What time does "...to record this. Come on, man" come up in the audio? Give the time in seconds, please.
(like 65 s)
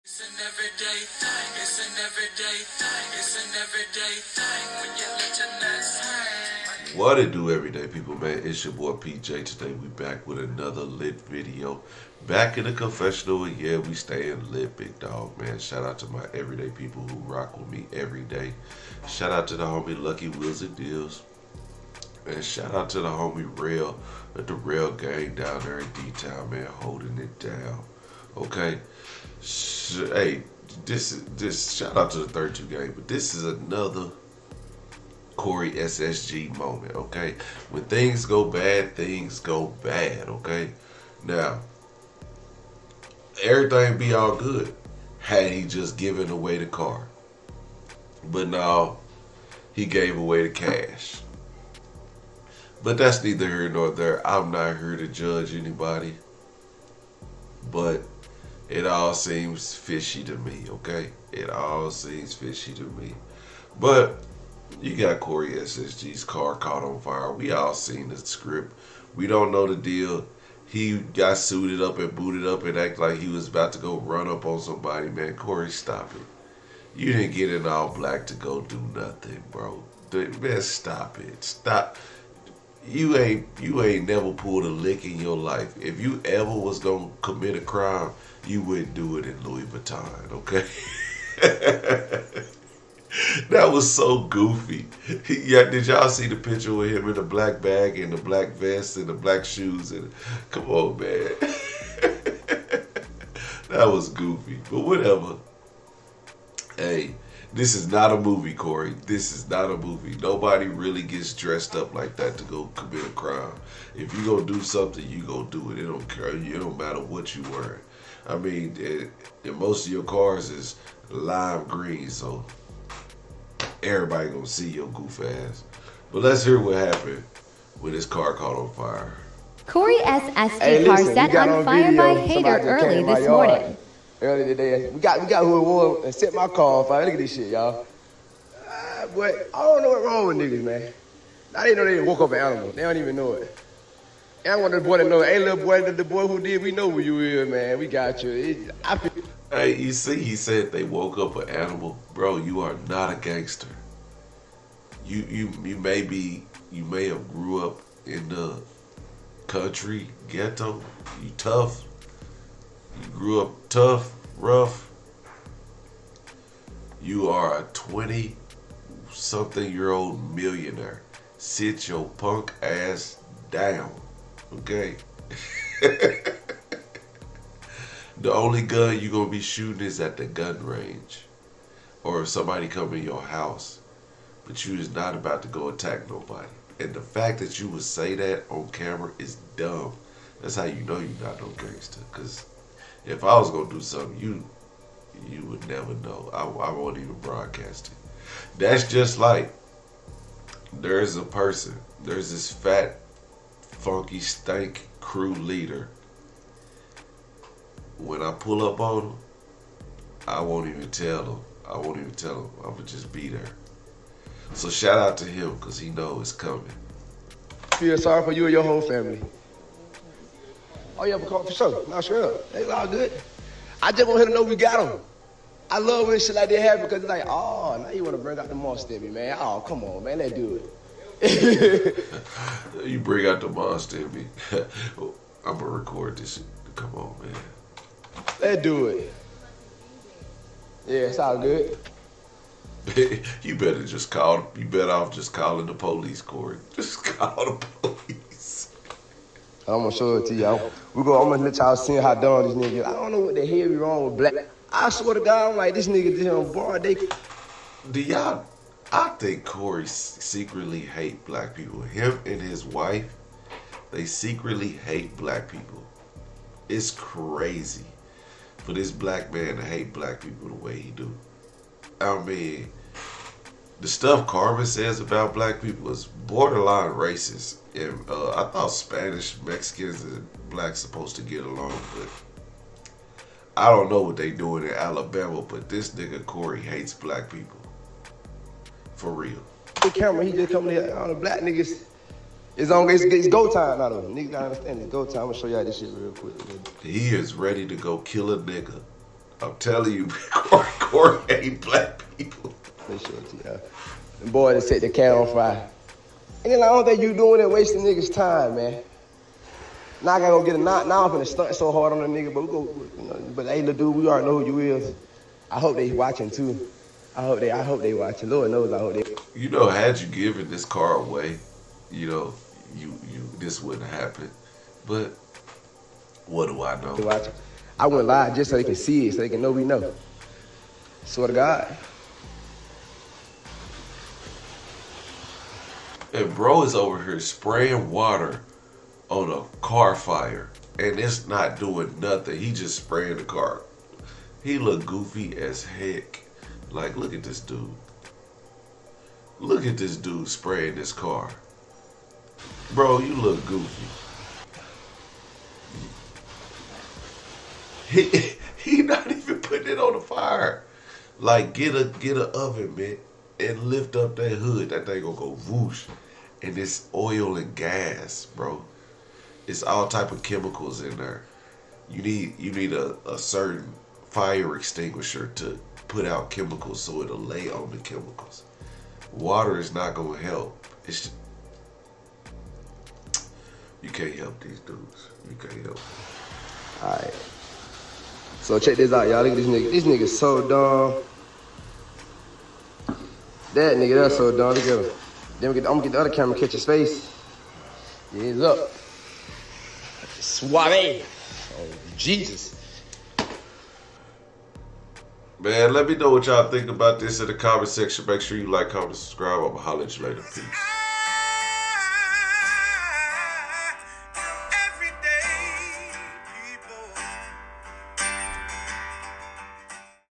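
235 s.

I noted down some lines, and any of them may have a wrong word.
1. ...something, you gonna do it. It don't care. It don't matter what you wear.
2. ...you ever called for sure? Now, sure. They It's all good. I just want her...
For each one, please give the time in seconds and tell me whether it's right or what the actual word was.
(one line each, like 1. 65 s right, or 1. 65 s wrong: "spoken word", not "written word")
1. 114 s right
2. 221 s right.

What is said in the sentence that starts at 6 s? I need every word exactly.
What it do everyday people, man?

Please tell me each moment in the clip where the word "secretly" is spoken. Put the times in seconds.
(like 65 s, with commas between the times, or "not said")
259 s, 264 s.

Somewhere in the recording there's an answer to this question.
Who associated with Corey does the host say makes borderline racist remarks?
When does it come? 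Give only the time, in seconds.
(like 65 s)
274 s.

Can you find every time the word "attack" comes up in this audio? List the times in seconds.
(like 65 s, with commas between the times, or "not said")
185 s.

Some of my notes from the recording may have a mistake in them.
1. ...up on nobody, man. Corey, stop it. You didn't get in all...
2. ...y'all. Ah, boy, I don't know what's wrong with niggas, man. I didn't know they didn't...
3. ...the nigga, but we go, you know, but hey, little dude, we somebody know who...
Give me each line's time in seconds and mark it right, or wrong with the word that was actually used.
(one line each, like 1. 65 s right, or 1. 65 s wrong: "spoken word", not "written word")
1. 74 s wrong: "somebody", not "nobody"
2. 137 s right
3. 312 s wrong: "already", not "somebody".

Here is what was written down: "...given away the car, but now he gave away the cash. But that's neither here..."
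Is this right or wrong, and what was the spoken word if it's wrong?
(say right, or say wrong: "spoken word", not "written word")
right.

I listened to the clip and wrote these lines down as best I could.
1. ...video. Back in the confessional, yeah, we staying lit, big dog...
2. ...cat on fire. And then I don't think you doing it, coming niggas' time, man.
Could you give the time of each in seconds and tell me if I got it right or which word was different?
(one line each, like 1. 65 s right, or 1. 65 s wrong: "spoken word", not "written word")
1. 11 s right
2. 304 s wrong: "wasting", not "coming".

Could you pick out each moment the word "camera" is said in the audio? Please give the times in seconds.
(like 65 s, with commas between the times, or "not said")
188 s, 289 s, 396 s.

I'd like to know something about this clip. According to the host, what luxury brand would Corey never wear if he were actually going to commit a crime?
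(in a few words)
Louis Vuitton.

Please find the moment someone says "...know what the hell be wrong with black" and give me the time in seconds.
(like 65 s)
253 s.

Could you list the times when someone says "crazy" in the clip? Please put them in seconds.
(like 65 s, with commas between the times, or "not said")
266 s.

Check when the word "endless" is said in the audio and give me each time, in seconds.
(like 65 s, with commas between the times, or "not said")
not said.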